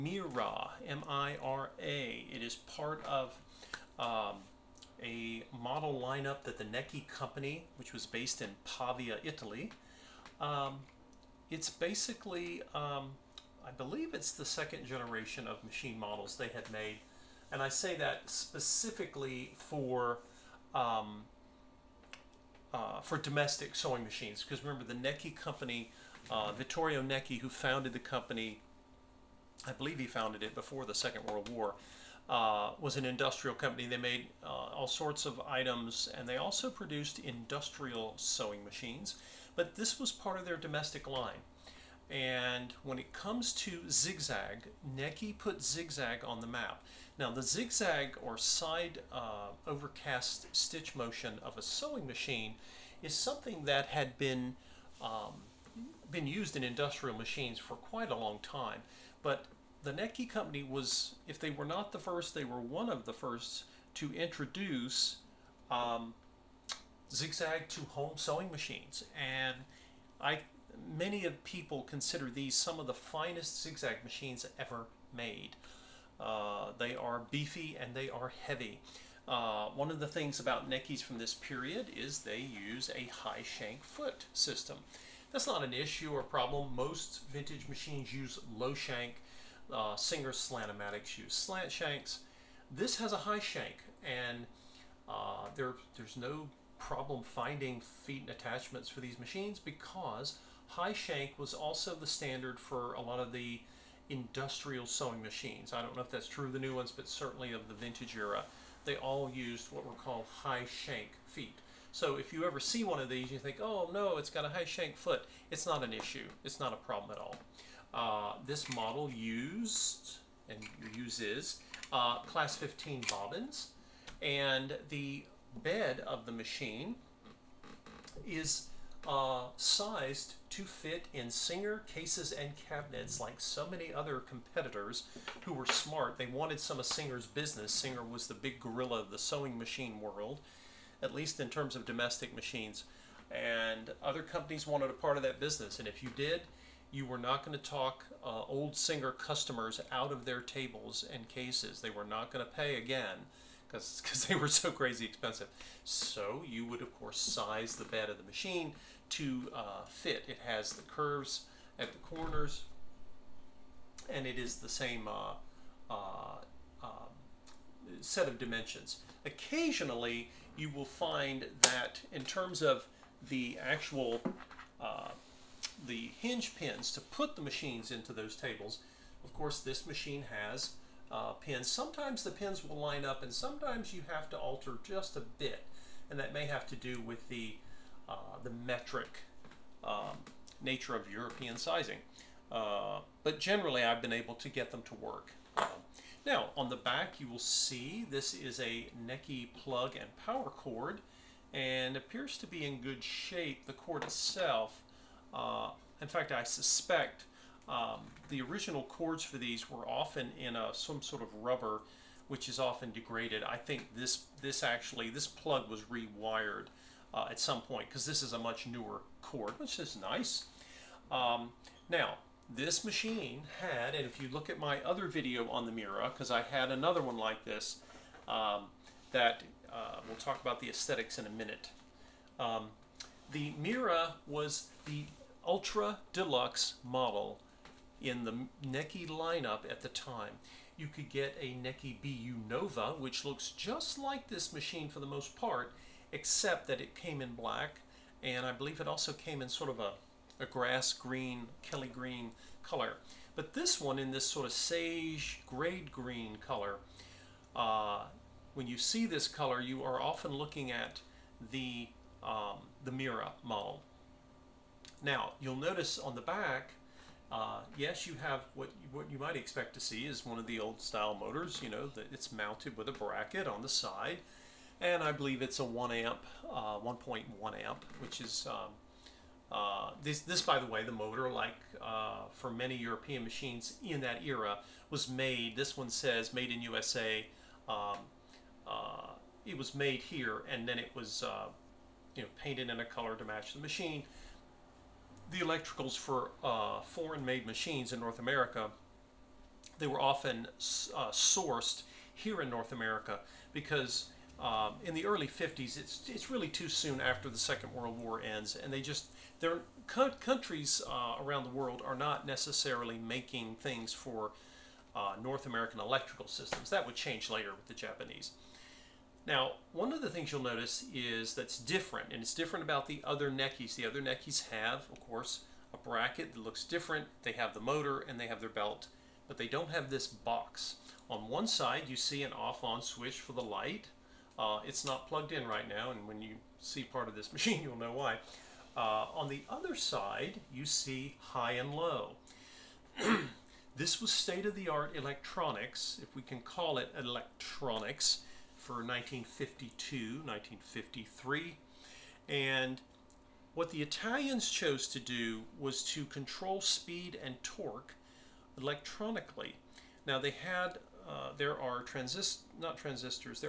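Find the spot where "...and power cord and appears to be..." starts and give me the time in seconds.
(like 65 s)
199 s.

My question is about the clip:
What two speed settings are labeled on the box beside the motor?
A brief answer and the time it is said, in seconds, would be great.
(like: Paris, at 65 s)
High and low, at 341 s.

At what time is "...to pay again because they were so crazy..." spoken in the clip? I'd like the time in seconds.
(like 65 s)
152 s.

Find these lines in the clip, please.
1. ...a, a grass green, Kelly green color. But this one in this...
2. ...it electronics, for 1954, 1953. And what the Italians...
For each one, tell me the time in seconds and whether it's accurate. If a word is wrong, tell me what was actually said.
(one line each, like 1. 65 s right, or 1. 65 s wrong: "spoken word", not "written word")
1. 249 s right
2. 346 s wrong: "1952", not "1954".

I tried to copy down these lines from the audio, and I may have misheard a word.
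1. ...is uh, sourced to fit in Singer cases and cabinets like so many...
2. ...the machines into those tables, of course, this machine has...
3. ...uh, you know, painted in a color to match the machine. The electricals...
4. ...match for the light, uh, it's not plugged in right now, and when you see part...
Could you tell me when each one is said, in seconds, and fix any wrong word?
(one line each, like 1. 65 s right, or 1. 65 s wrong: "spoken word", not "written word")
1. 128 s wrong: "sized", not "sourced"
2. 177 s right
3. 291 s right
4. 332 s wrong: "switch", not "match".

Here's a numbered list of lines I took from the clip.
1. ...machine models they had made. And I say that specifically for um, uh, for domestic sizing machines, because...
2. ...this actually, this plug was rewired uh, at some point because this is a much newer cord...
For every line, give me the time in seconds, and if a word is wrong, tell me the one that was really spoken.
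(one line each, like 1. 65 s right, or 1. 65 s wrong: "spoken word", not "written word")
1. 15 s wrong: "sewing", not "sizing"
2. 214 s right.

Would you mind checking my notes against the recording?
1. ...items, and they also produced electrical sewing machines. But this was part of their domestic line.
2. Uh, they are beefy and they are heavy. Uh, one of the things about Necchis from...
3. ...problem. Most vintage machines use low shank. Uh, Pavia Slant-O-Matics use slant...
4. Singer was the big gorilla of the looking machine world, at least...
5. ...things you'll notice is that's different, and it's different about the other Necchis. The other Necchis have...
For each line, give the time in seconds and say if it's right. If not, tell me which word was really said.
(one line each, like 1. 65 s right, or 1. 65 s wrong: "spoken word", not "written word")
1. 35 s wrong: "industrial", not "electrical"
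2. 76 s right
3. 86 s wrong: "Singer", not "Pavia"
4. 137 s wrong: "sewing", not "looking"
5. 320 s right.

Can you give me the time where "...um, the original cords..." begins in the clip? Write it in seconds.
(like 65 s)
207 s.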